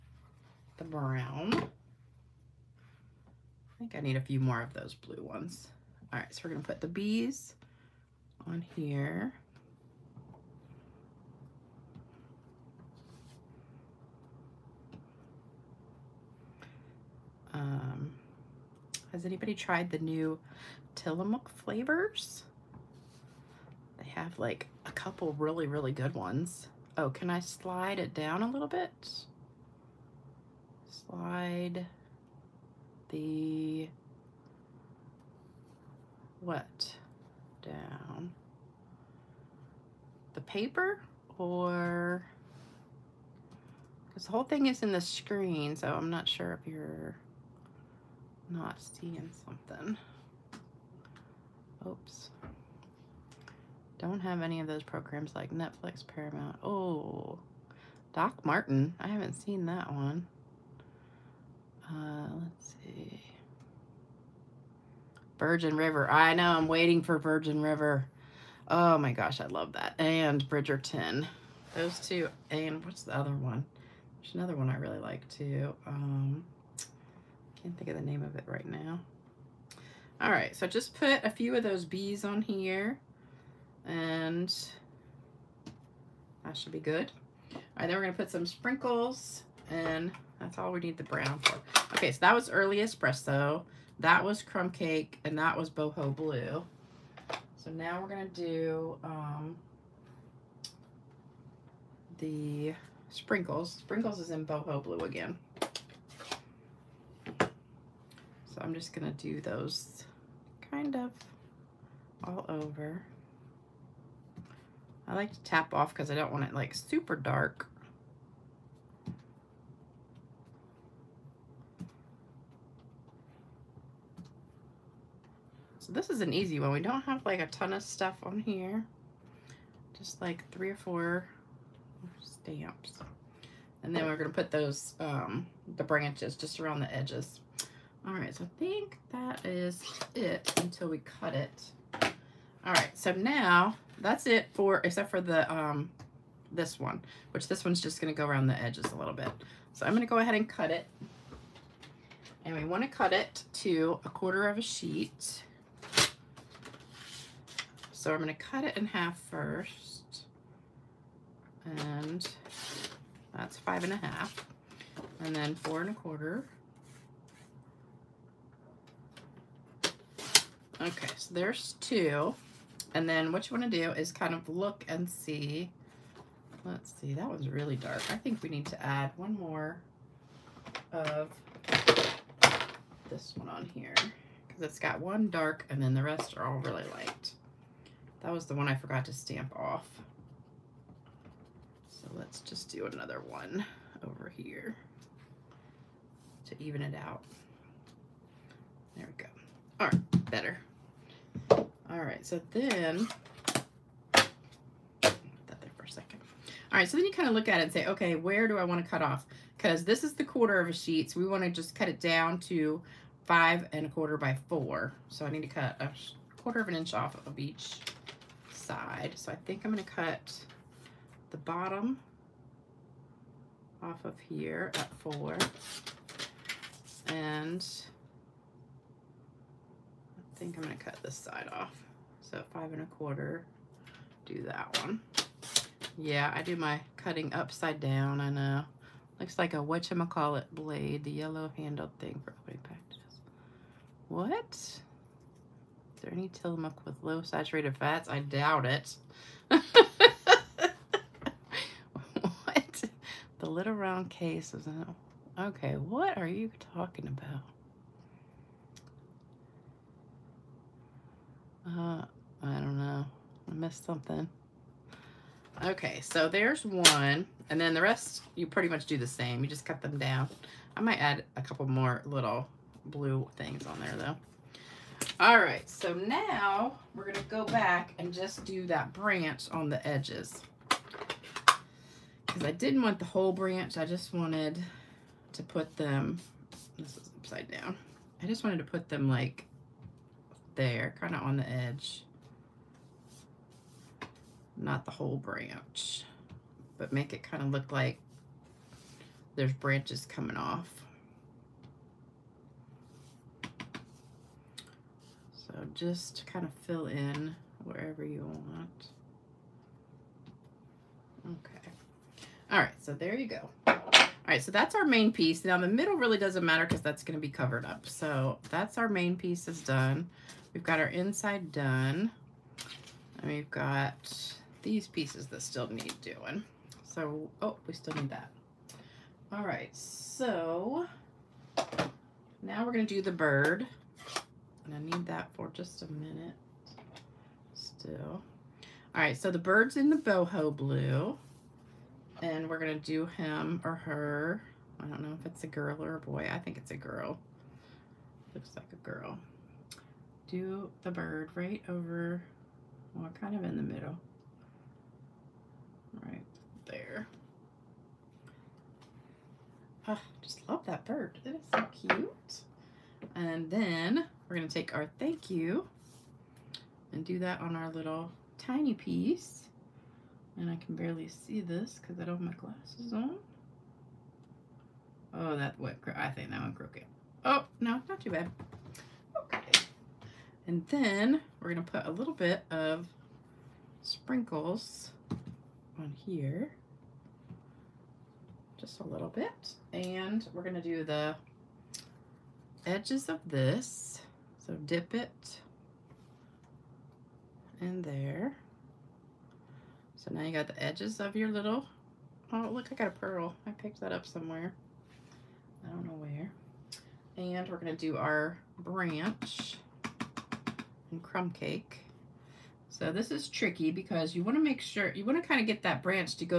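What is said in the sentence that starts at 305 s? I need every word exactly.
So just kind of fill in wherever you want.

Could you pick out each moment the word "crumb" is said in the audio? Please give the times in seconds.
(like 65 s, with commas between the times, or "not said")
94 s, 411 s.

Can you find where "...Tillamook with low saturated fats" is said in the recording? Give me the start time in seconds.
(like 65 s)
246 s.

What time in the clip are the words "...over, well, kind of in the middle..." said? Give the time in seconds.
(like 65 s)
351 s.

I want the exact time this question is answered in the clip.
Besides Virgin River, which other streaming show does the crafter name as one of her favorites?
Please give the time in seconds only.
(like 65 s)
70 s.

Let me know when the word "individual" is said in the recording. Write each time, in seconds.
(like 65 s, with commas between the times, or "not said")
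not said.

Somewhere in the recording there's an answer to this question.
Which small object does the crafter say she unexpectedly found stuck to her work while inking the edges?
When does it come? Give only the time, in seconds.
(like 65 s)
402 s.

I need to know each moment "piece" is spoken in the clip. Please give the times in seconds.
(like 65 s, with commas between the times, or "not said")
315 s, 319 s, 324 s, 368 s.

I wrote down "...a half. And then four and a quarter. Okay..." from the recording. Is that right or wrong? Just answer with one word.
right.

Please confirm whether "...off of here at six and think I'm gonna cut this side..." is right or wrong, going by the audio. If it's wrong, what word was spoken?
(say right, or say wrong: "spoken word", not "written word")
wrong: "four", not "six".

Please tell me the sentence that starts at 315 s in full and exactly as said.
Now the middle really doesn't matter because that's going to be covered up.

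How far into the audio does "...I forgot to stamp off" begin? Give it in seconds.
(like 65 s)
188 s.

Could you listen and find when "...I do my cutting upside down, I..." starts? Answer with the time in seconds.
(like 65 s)
236 s.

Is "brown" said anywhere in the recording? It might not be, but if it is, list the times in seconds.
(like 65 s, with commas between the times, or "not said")
0 s, 91 s.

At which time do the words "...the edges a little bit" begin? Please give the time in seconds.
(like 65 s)
148 s.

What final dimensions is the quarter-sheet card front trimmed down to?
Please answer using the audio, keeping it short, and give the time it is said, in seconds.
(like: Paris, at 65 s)
5 1/4 by 4, at 213 s.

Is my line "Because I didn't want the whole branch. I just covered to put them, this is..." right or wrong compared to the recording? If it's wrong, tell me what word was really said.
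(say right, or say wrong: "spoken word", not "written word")
wrong: "wanted", not "covered".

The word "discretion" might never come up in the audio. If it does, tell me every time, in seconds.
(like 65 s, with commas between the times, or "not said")
not said.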